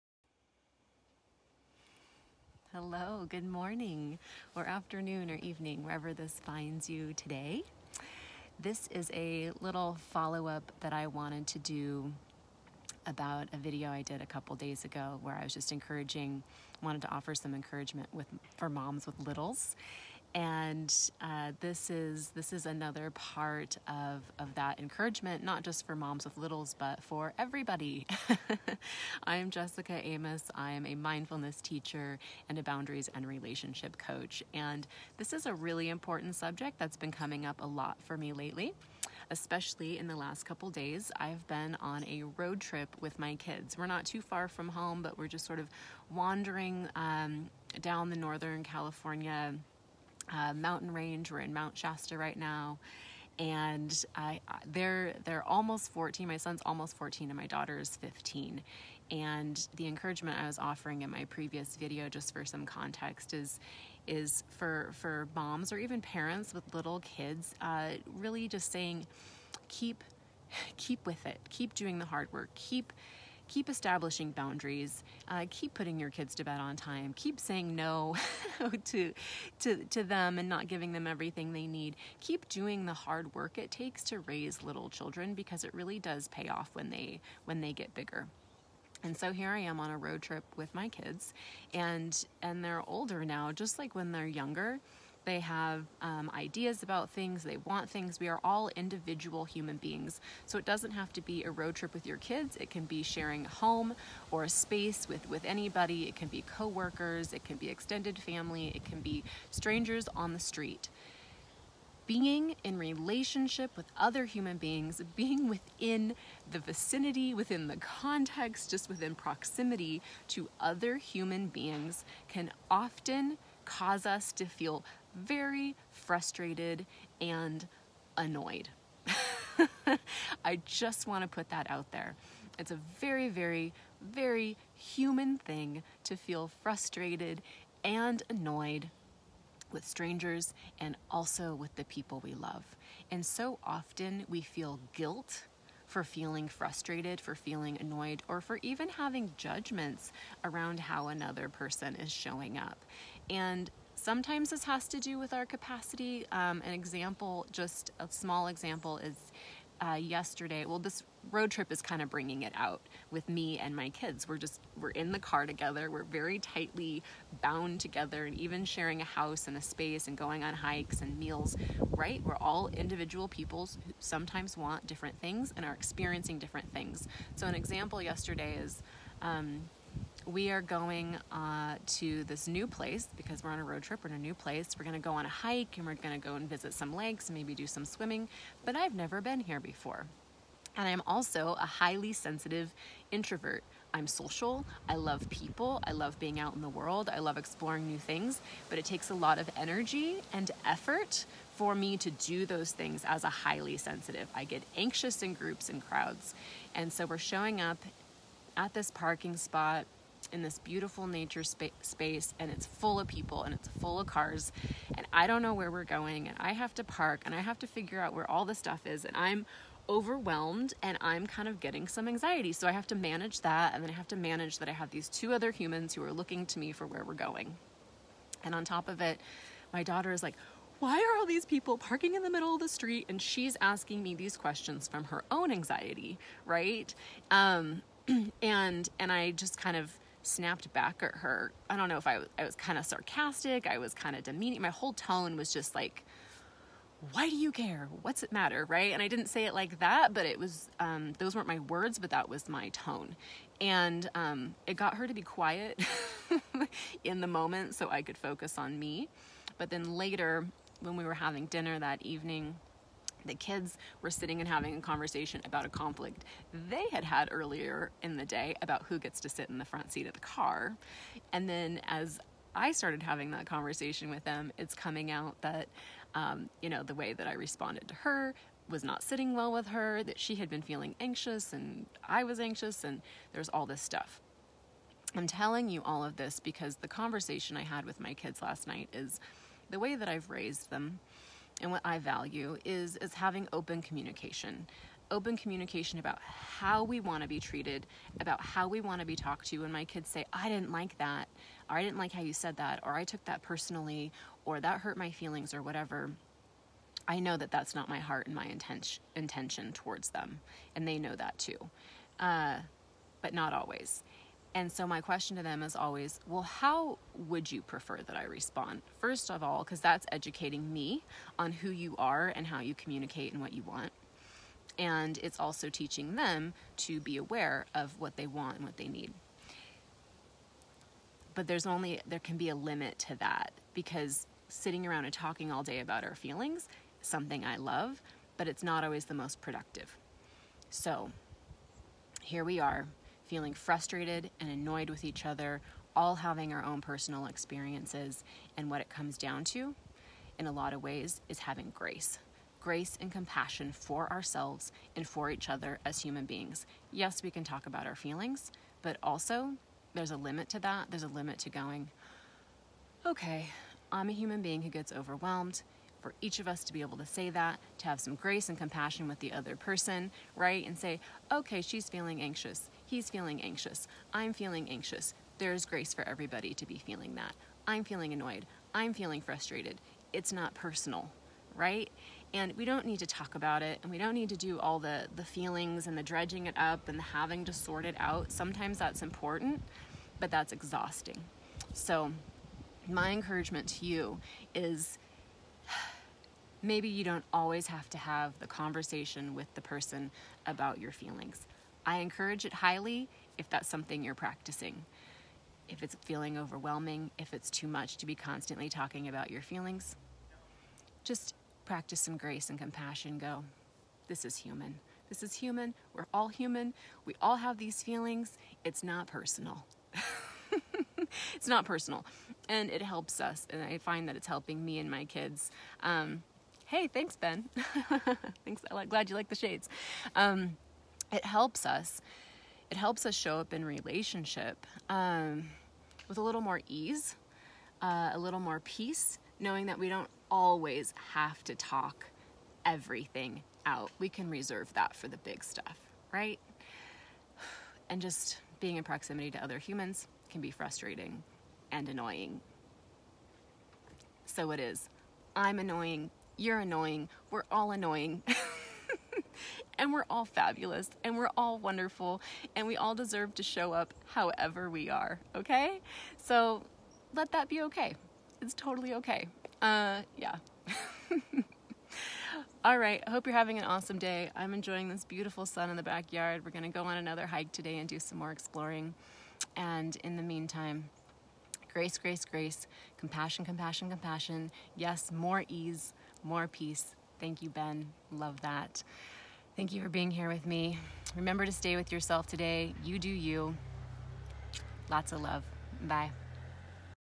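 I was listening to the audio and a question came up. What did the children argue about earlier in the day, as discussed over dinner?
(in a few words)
Front seat of the car.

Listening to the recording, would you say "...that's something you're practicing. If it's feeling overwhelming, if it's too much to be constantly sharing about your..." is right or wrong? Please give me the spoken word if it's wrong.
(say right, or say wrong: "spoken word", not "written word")
wrong: "talking", not "sharing".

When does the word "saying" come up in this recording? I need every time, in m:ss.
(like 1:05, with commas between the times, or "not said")
1:08, 1:17.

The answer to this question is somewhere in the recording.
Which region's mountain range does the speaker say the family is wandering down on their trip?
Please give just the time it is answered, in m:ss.
0:48.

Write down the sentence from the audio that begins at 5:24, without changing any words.
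And it's also teaching them to be aware of what they want and what they need.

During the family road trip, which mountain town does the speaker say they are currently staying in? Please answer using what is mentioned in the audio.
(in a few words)
Mount Shasta.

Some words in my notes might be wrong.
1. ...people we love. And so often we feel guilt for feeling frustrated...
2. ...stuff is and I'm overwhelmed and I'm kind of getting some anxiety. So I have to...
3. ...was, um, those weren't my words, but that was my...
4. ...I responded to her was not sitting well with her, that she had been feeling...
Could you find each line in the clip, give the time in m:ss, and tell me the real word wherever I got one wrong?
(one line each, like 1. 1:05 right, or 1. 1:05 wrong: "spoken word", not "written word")
1. 2:21 right
2. 3:38 right
3. 4:10 right
4. 4:37 right.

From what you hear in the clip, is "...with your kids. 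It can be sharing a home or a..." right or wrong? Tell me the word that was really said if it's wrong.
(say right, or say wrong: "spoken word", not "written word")
right.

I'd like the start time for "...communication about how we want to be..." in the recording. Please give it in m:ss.
4:55.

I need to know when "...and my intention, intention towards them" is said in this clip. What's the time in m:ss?
5:08.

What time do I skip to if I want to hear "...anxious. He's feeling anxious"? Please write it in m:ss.
6:12.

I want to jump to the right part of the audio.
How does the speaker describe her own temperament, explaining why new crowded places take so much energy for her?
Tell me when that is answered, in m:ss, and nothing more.
3:11.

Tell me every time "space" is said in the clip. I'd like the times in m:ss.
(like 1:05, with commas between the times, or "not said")
1:44, 2:49, 3:31.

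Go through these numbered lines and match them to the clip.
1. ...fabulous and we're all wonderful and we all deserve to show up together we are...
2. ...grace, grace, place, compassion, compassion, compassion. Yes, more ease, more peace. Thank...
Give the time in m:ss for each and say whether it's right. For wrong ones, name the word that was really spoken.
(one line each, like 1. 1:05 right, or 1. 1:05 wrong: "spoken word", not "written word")
1. 7:40 wrong: "however", not "together"
2. 8:01 wrong: "grace", not "place".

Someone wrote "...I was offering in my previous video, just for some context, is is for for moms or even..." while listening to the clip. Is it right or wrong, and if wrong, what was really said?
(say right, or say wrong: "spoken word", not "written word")
right.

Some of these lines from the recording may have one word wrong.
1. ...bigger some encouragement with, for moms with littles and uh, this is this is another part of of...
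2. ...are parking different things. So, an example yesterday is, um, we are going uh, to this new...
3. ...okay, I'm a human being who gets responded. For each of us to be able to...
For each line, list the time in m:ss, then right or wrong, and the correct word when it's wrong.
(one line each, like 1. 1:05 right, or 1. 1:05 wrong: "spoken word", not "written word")
1. 0:17 wrong: "offer", not "bigger"
2. 2:55 wrong: "experiencing", not "parking"
3. 6:03 wrong: "overwhelmed", not "responded".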